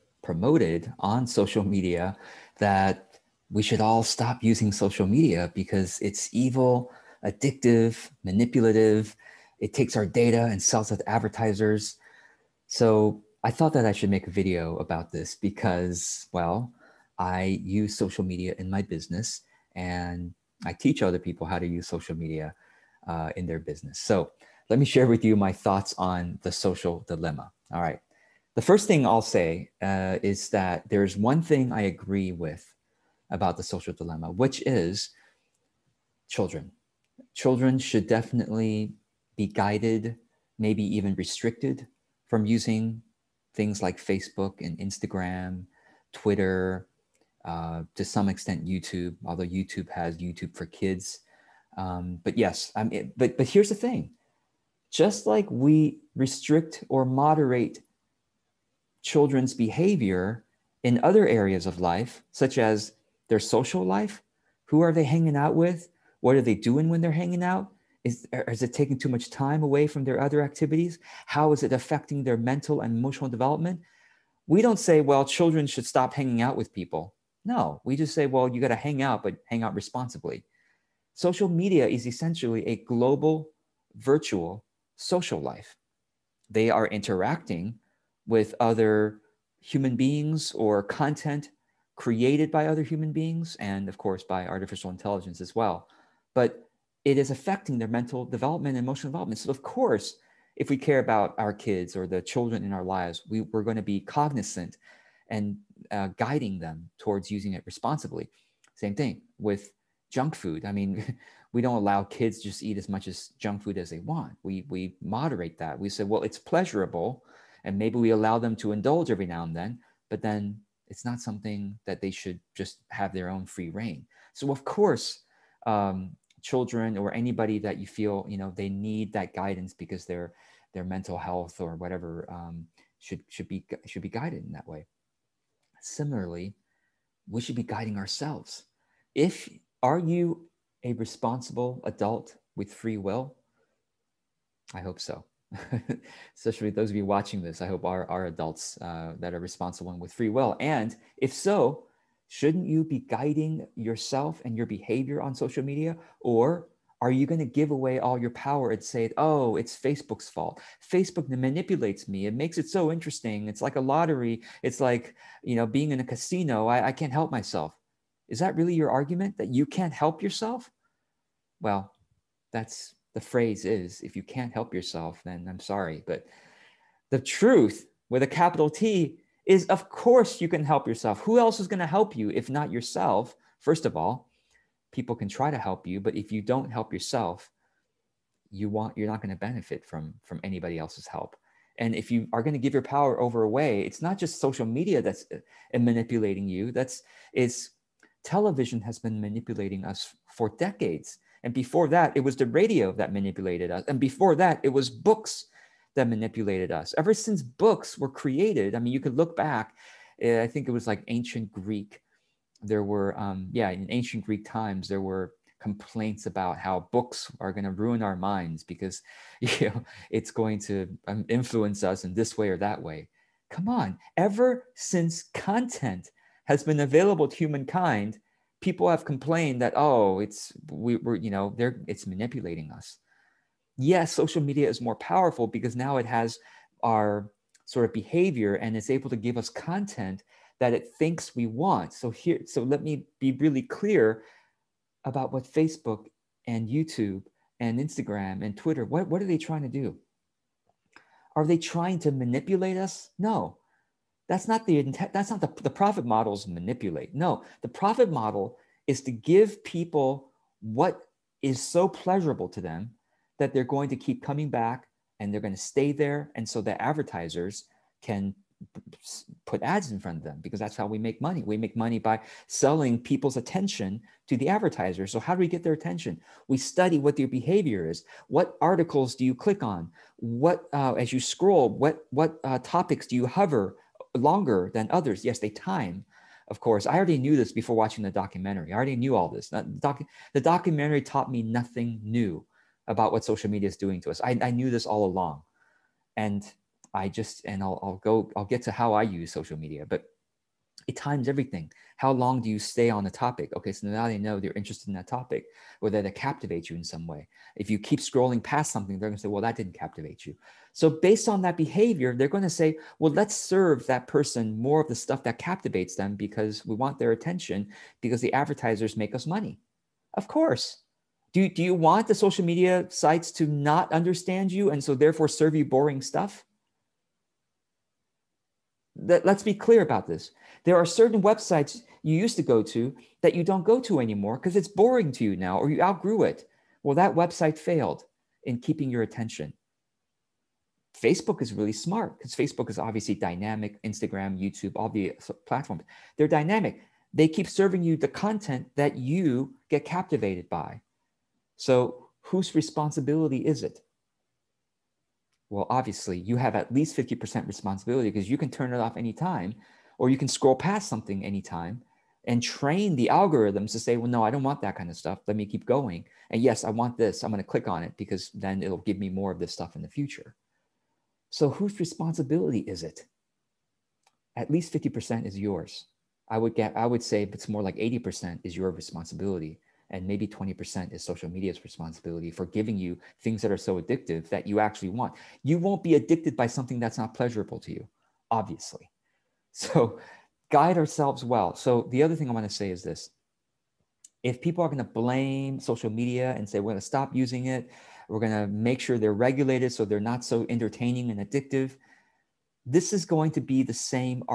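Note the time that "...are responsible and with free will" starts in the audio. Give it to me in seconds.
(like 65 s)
149 s.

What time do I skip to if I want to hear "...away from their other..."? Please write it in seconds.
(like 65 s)
69 s.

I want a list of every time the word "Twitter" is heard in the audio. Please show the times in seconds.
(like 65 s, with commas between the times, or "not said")
46 s, 248 s.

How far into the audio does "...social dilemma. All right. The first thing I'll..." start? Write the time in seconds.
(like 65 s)
26 s.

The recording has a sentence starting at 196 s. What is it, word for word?
That's it's television has been manipulating us for decades.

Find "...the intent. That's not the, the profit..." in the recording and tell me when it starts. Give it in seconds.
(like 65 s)
254 s.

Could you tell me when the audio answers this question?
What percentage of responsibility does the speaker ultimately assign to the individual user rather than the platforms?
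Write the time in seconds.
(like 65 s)
377 s.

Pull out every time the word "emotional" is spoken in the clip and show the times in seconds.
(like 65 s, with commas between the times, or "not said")
72 s, 98 s.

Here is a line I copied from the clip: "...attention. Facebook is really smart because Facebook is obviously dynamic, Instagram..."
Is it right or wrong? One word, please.
right.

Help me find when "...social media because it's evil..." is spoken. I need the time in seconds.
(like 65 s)
4 s.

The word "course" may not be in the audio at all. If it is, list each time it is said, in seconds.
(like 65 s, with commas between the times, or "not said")
93 s, 99 s, 124 s, 179 s, 286 s, 320 s.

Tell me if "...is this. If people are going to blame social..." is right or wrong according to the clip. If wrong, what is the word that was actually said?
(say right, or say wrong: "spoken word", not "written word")
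right.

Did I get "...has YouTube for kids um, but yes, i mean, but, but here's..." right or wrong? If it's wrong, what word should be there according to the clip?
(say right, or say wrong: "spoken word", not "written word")
right.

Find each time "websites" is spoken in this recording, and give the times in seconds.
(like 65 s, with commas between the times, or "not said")
331 s, 337 s.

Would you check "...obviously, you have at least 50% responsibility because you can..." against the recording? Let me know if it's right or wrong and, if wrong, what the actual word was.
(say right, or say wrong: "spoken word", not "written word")
right.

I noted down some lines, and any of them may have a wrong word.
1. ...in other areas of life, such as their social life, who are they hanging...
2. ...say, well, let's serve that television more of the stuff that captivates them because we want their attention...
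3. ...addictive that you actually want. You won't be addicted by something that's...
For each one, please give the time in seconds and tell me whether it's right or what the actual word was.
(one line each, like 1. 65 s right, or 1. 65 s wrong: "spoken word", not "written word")
1. 60 s right
2. 312 s wrong: "person", not "television"
3. 383 s right.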